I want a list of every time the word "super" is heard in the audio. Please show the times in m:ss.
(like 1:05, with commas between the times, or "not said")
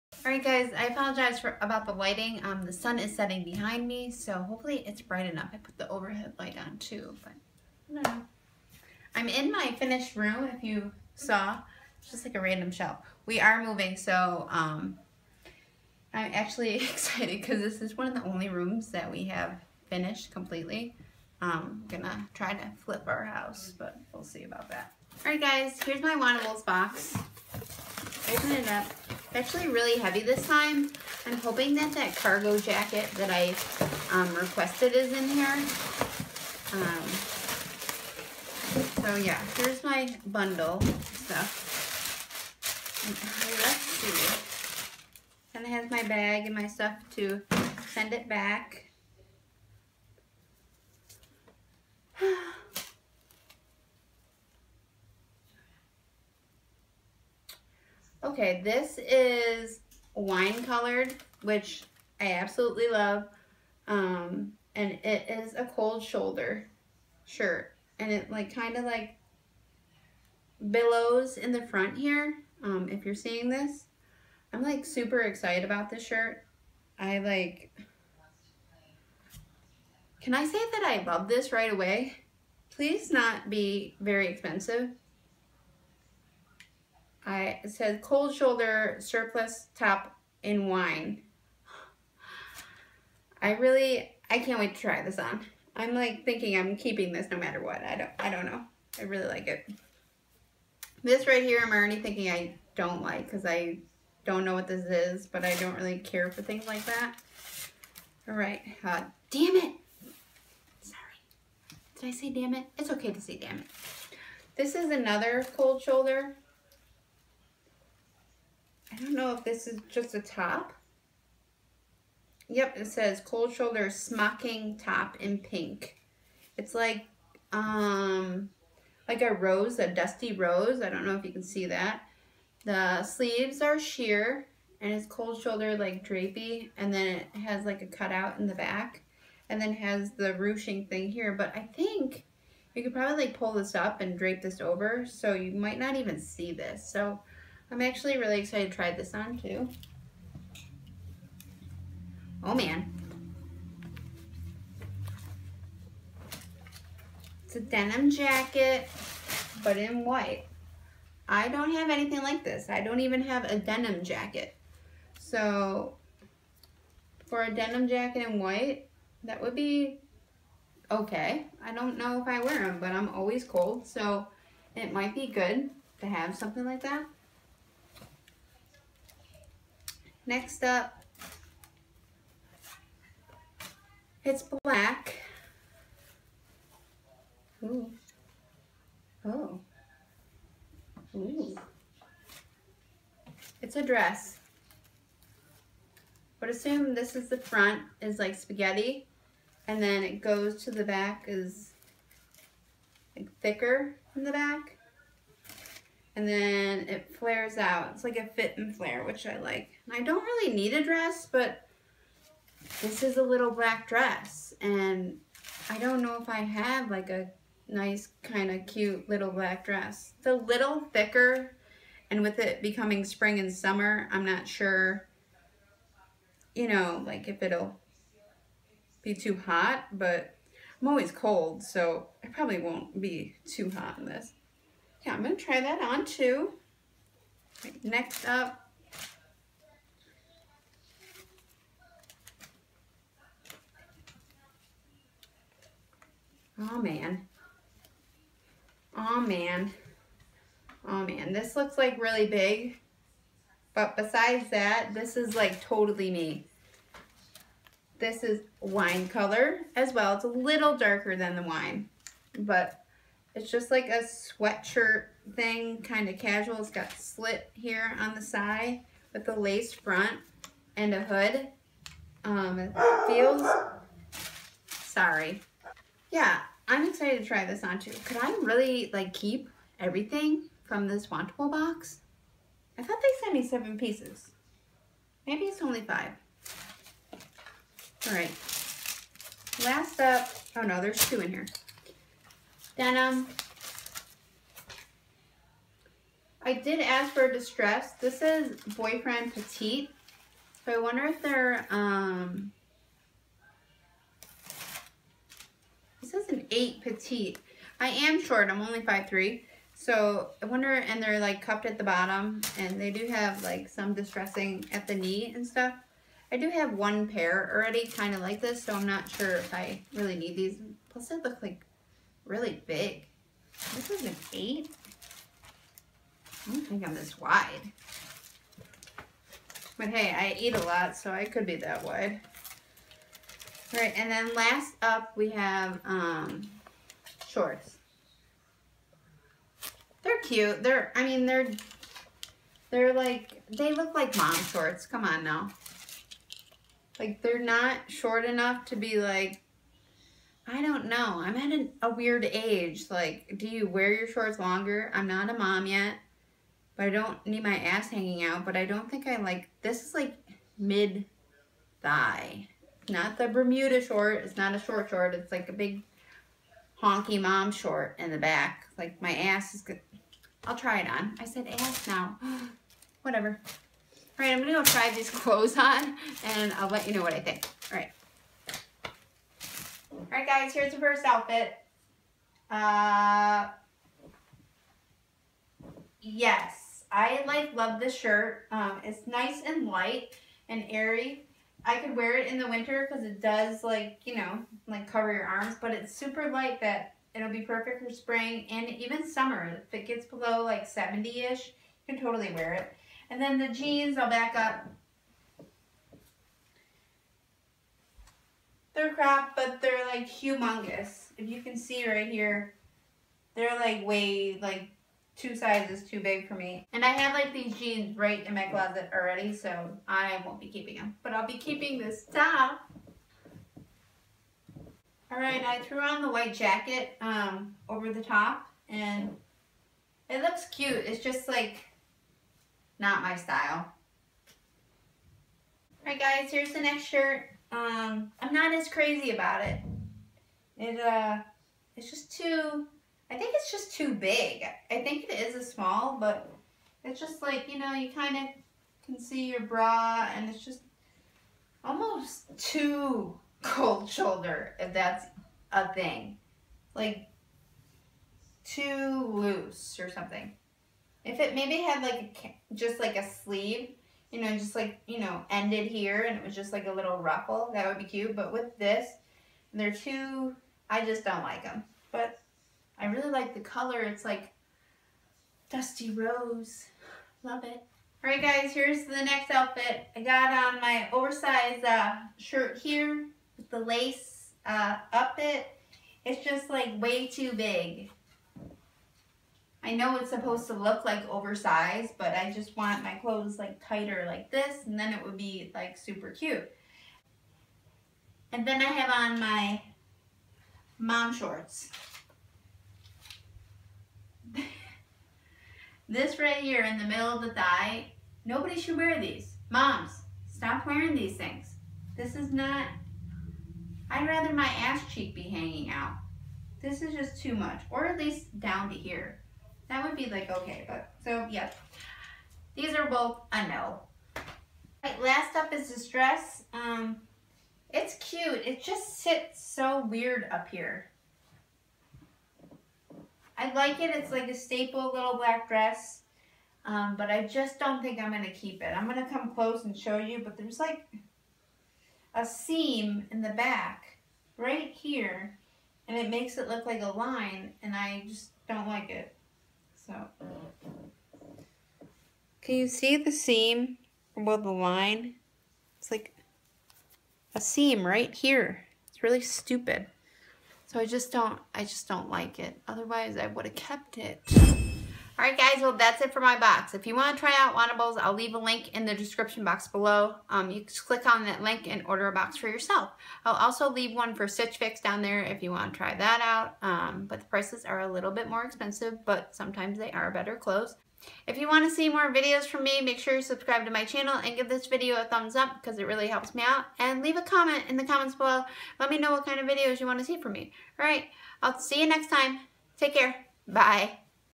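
1:14, 6:35, 8:15.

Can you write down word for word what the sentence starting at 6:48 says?
They're crap, but they're like humongous.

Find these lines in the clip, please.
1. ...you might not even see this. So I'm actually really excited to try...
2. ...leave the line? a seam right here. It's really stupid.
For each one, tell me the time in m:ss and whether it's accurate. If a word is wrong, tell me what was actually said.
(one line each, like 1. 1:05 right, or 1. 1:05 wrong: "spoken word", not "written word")
1. 2:25 right
2. 9:14 wrong: "above", not "leave".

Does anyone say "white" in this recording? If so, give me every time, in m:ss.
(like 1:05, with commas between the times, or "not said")
2:40, 2:48, 7:06.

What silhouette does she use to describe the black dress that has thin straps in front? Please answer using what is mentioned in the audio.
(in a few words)
Fit and flare.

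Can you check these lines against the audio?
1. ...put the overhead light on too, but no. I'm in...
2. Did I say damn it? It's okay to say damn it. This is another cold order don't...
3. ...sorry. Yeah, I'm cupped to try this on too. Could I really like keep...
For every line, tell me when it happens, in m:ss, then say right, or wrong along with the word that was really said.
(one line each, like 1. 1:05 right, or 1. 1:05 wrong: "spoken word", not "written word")
1. 0:05 right
2. 1:51 wrong: "shoulder", not "order"
3. 4:34 wrong: "excited", not "cupped".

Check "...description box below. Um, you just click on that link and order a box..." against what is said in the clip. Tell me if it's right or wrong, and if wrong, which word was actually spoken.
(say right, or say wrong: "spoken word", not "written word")
right.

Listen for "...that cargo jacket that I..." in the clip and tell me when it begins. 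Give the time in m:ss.
0:31.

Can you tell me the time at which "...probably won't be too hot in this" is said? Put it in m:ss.
3:52.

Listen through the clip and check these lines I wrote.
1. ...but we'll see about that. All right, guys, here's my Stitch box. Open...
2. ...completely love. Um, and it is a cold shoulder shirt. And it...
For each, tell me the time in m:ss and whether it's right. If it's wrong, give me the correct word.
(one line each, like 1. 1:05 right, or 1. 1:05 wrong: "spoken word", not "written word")
1. 0:23 wrong: "Wantables", not "Stitch"
2. 1:02 wrong: "absolutely", not "completely".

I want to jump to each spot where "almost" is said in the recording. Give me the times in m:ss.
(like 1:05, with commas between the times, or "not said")
7:31.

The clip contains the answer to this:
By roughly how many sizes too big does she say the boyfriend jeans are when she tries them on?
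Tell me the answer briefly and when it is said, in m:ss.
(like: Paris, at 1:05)
2, at 6:55.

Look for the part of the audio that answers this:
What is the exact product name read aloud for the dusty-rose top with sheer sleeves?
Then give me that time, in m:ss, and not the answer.
2:03.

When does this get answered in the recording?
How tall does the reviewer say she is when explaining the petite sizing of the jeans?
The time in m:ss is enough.
5:08.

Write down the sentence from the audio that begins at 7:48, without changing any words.
But with this, they're too I just don't like them.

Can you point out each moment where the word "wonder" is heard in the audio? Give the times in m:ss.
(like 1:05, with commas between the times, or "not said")
5:00, 5:10.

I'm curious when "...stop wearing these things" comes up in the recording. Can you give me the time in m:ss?
8:30.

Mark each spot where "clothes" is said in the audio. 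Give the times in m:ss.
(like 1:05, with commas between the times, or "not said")
6:15, 8:12, 9:40.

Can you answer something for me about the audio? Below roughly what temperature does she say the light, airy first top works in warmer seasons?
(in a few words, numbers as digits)
70.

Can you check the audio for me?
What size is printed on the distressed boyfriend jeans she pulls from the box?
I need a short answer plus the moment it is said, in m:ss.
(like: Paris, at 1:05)
8 Petite, at 5:06.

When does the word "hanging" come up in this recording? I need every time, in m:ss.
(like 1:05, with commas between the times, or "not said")
5:57, 8:35.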